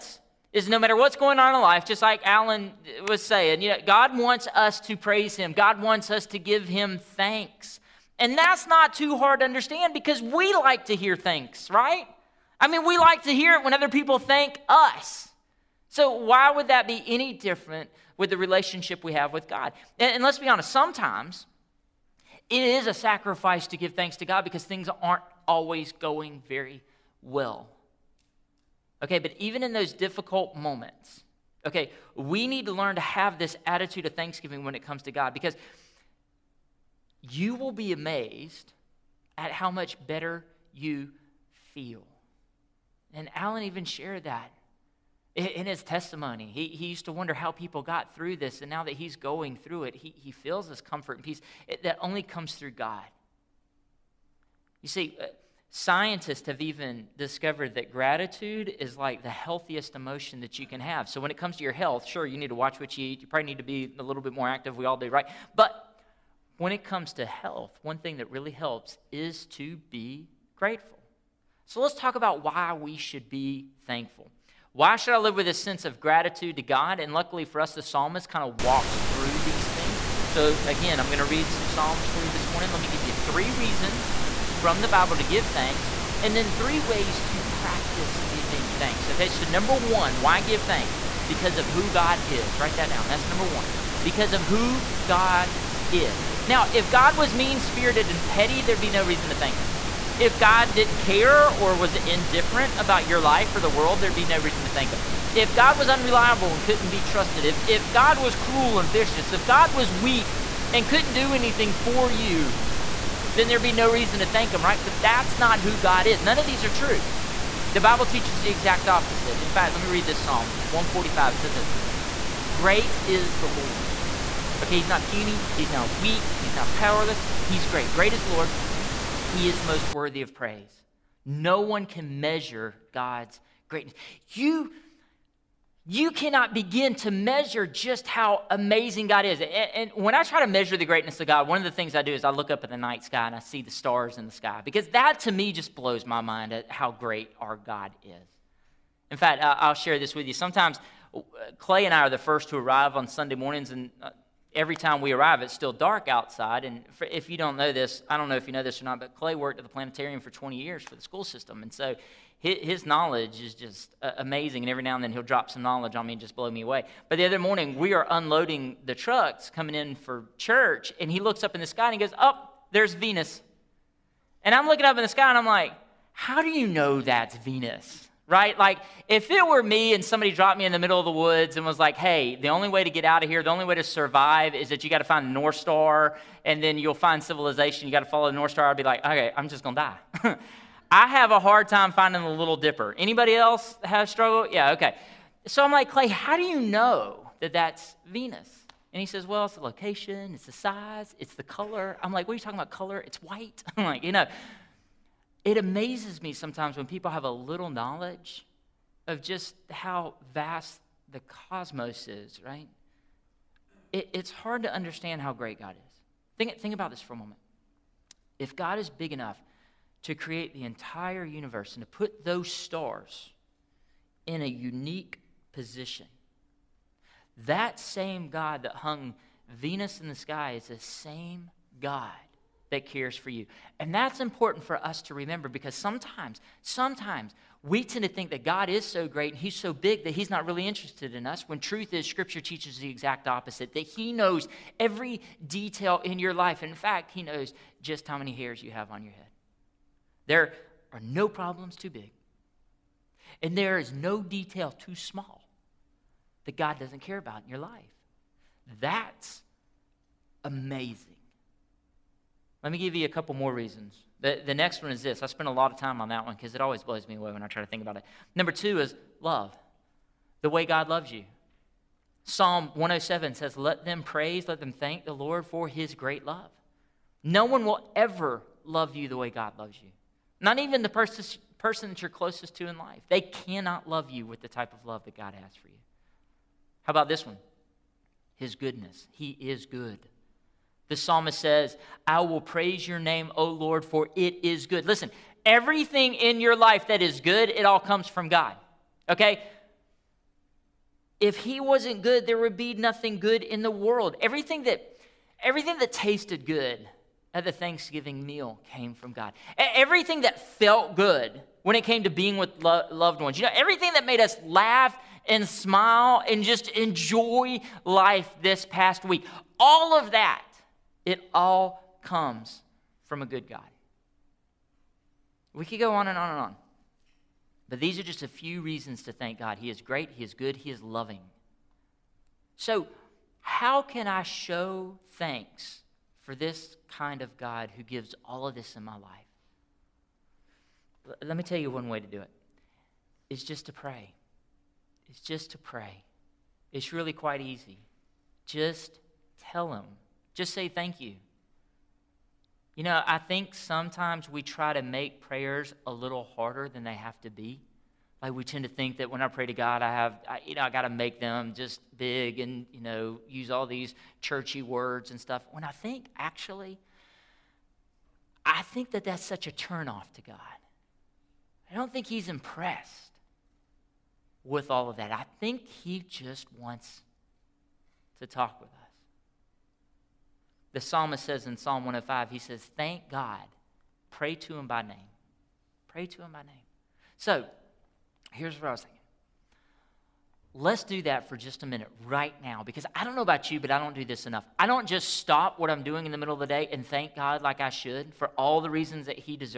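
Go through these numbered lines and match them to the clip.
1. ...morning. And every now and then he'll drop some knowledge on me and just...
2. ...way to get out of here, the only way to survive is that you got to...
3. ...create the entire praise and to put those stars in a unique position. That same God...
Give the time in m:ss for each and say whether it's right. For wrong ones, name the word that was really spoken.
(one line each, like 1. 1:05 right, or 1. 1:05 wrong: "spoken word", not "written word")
1. 2:44 wrong: "amazing", not "morning"
2. 3:02 right
3. 3:40 wrong: "universe", not "praise".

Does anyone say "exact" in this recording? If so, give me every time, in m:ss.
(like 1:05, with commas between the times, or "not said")
1:58, 4:02.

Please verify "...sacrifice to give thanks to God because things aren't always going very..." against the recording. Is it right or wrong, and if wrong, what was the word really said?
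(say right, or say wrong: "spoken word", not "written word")
right.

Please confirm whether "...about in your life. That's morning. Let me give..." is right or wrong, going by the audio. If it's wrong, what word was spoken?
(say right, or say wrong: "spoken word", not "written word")
wrong: "amazing", not "morning".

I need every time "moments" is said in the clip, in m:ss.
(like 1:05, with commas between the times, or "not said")
0:30, 3:37.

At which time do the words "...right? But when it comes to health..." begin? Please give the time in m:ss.
1:05.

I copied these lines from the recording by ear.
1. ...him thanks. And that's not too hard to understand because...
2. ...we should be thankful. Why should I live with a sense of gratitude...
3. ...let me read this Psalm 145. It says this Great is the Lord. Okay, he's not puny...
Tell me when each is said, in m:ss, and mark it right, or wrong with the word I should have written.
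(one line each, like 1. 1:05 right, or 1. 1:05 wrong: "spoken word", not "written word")
1. 0:06 right
2. 1:12 right
3. 1:59 right.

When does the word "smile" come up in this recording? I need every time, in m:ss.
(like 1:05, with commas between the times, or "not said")
5:15.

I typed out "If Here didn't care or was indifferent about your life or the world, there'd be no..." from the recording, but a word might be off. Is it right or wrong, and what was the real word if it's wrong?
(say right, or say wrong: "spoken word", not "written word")
wrong: "God", not "Here".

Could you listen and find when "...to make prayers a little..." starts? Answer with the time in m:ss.
5:54.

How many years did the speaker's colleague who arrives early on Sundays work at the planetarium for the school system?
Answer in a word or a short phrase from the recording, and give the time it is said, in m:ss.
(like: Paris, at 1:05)
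20, at 2:40.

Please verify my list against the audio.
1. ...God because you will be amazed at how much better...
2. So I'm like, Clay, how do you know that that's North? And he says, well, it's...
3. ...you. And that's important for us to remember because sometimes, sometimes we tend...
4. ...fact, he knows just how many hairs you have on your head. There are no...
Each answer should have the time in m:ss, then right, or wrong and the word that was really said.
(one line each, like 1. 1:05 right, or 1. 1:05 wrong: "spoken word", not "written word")
1. 0:35 right
2. 3:15 wrong: "Venus", not "North"
3. 3:53 right
4. 4:06 right.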